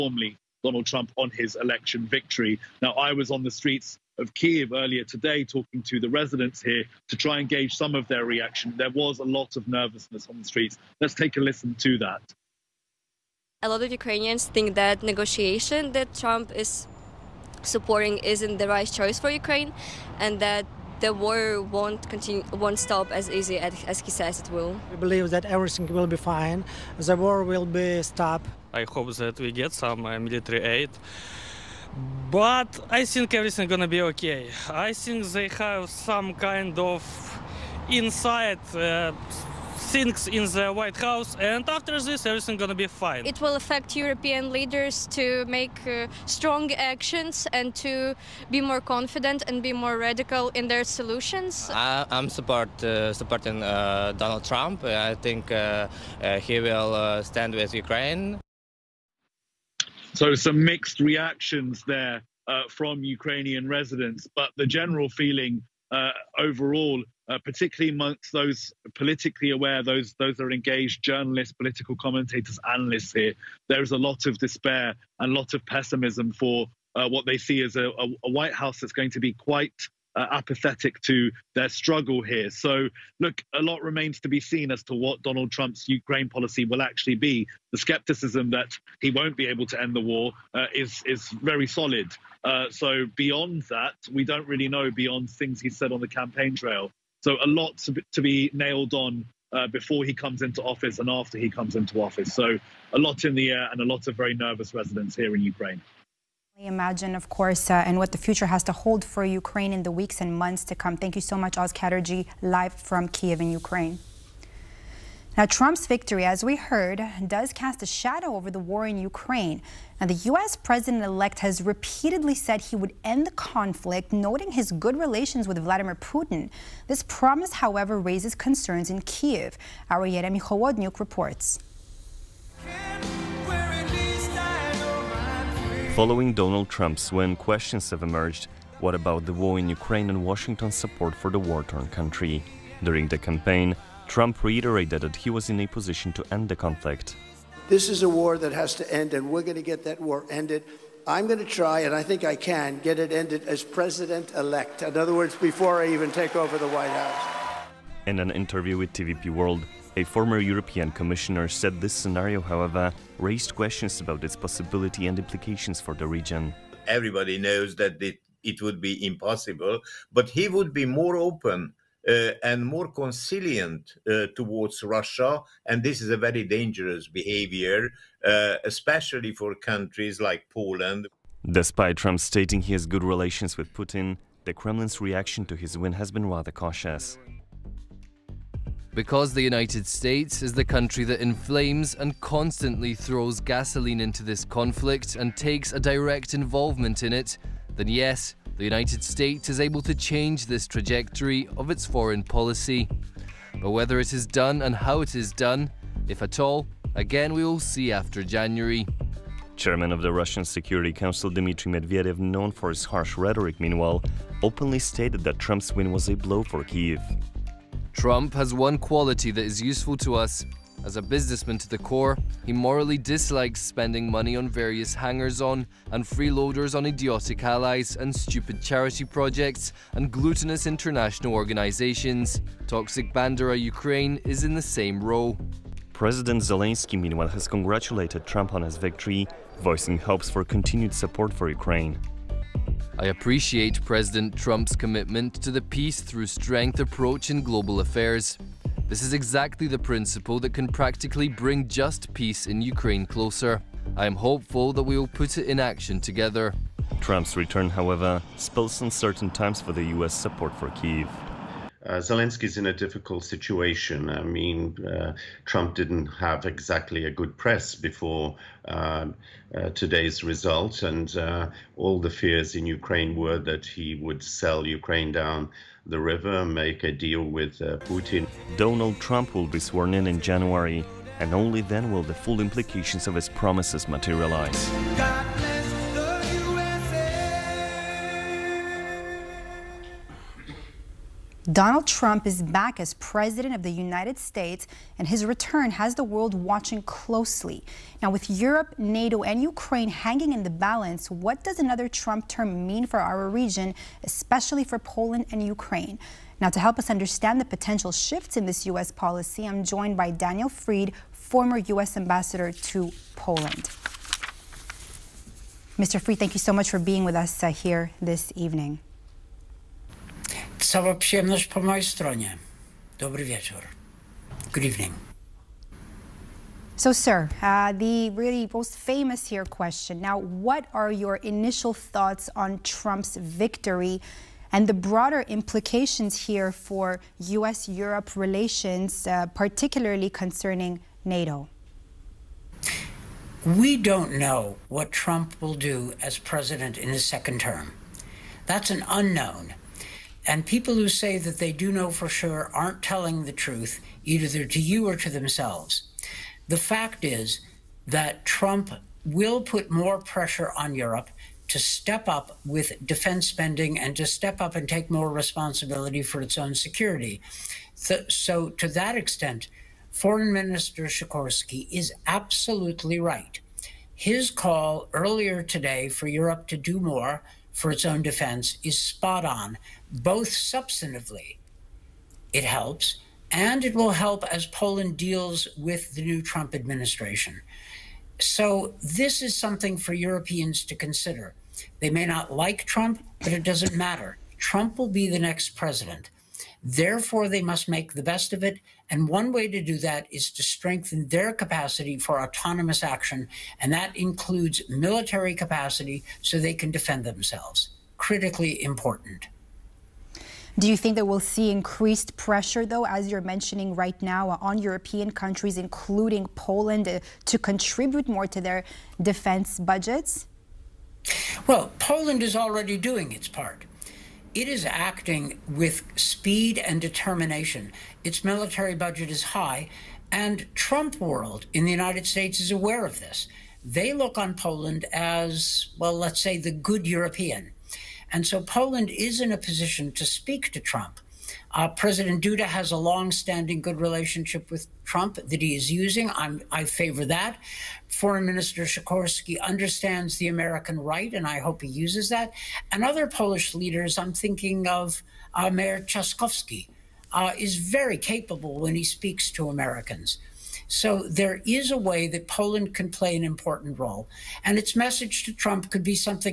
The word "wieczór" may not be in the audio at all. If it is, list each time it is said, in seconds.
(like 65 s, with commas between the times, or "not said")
323 s.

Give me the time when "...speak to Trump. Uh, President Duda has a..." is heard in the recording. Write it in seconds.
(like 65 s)
440 s.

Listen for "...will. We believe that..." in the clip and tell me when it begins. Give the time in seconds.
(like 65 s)
24 s.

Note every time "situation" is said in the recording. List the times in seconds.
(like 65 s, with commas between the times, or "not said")
263 s.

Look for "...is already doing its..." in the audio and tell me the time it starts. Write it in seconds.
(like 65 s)
422 s.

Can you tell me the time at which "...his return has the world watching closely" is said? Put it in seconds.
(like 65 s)
295 s.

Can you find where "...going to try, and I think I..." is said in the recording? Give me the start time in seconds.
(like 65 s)
151 s.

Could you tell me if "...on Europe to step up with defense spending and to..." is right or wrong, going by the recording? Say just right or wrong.
right.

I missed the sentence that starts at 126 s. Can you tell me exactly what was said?
This promise, however, raises concerns in Kiev.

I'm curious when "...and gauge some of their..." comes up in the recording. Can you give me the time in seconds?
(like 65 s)
7 s.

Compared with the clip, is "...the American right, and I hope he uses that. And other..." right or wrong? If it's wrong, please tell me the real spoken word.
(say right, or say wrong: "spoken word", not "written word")
right.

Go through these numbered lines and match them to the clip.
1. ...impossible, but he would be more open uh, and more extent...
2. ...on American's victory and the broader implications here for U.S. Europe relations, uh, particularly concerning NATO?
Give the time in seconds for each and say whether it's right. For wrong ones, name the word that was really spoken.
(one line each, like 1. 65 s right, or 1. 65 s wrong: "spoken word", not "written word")
1. 169 s wrong: "conciliant", not "extent"
2. 332 s wrong: "Trump", not "American".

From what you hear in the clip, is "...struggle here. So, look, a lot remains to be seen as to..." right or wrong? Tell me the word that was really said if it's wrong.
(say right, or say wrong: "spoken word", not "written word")
right.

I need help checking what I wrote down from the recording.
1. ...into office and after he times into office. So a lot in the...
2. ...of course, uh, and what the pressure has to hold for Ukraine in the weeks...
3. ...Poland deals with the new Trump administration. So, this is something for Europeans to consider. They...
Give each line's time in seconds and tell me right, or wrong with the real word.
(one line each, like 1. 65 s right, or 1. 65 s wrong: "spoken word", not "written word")
1. 100 s wrong: "comes", not "times"
2. 107 s wrong: "future", not "pressure"
3. 384 s right.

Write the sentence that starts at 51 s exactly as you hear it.
I, am support uh, supporting uh, Donald Trump.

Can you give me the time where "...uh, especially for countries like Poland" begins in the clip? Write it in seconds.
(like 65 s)
178 s.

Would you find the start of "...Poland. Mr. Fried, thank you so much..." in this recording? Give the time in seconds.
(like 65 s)
313 s.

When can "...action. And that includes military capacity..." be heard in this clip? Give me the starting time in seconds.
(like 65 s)
402 s.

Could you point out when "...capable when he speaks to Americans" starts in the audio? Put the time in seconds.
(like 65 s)
457 s.